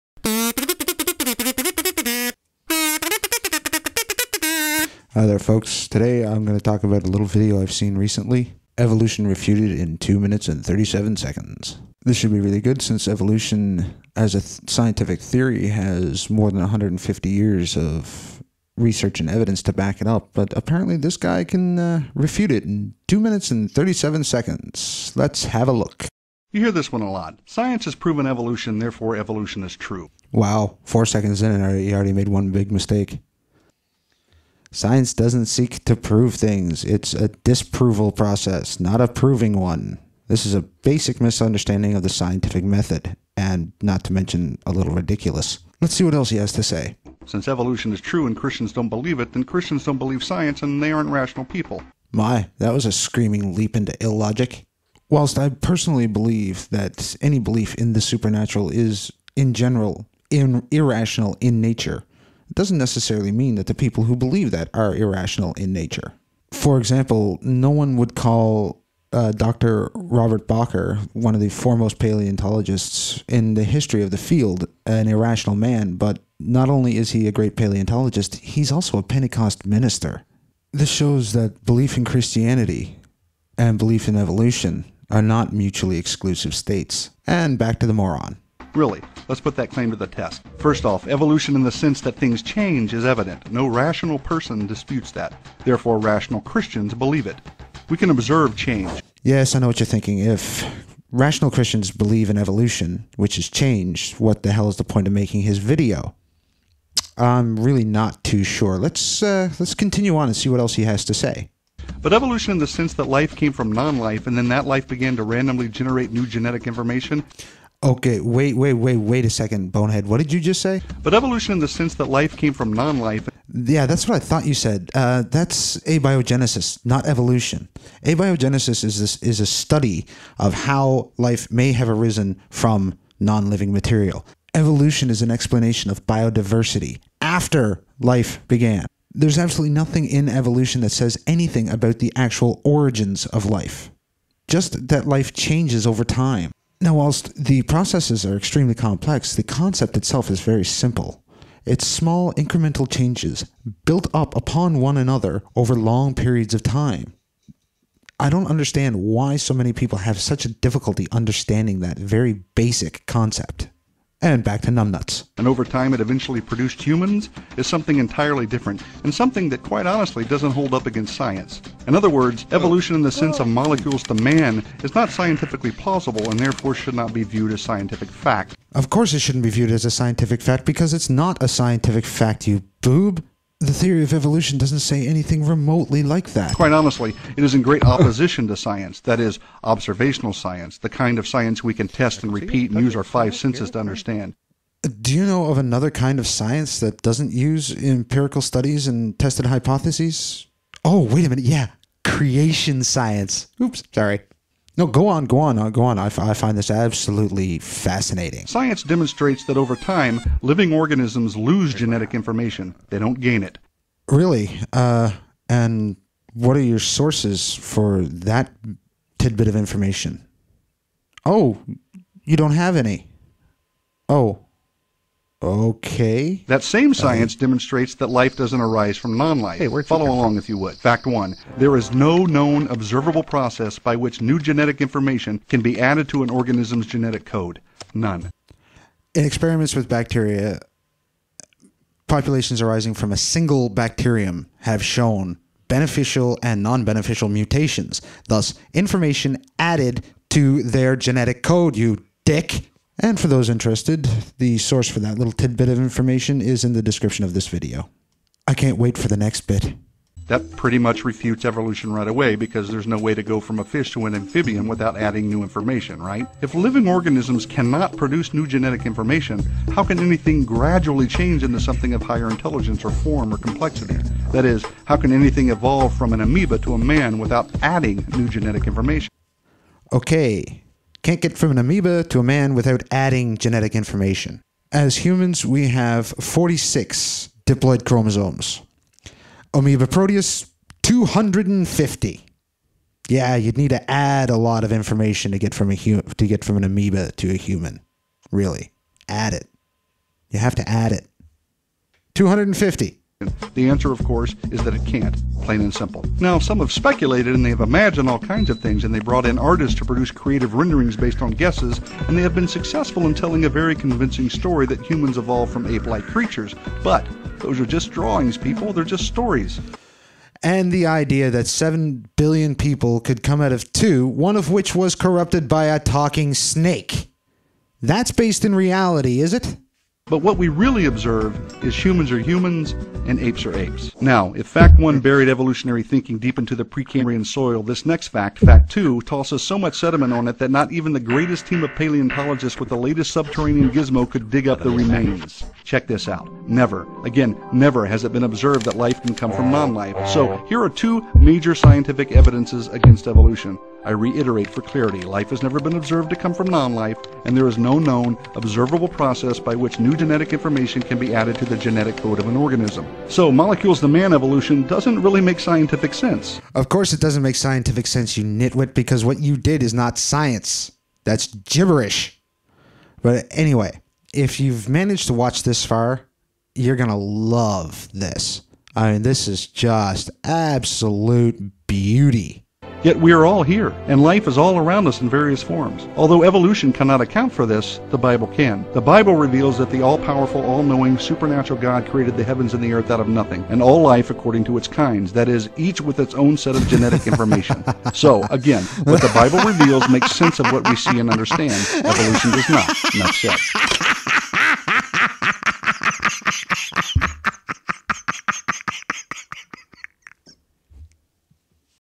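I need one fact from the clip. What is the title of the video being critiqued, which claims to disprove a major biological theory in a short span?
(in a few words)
Evolution Refuted in 2 minutes and 37 seconds.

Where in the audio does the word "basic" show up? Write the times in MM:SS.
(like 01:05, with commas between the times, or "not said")
00:40, 02:42.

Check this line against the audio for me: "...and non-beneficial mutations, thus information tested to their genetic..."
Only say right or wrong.
wrong.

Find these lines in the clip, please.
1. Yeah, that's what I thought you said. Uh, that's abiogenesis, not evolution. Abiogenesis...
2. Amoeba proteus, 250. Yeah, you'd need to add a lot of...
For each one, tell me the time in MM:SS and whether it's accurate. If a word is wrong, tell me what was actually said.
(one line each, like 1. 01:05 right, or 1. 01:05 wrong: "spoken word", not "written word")
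1. 02:03 right
2. 04:49 right.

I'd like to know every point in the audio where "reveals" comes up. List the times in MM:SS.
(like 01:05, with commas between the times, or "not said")
06:29, 06:39.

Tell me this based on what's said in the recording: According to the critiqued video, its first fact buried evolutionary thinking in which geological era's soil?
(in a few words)
Precambrian.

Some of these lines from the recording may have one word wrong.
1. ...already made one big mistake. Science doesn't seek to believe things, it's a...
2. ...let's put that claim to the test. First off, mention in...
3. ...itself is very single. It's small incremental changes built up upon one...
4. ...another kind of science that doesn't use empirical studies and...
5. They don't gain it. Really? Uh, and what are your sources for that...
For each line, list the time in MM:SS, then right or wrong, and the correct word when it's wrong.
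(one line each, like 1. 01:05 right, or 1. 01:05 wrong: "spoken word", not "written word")
1. 00:31 wrong: "prove", not "believe"
2. 01:29 wrong: "evolution", not "mention"
3. 02:29 wrong: "simple", not "single"
4. 03:15 right
5. 03:32 right.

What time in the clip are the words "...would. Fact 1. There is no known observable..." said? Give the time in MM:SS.
03:50.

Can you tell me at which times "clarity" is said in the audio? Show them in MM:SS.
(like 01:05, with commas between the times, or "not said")
05:54.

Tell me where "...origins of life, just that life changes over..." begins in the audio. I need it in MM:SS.
02:22.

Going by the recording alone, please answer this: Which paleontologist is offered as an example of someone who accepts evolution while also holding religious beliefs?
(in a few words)
Dr. Robert Bakker.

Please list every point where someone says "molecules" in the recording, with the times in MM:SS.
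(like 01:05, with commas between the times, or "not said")
02:53, 06:03.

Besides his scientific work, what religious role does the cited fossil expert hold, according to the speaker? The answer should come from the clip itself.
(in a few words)
Pentecost minister.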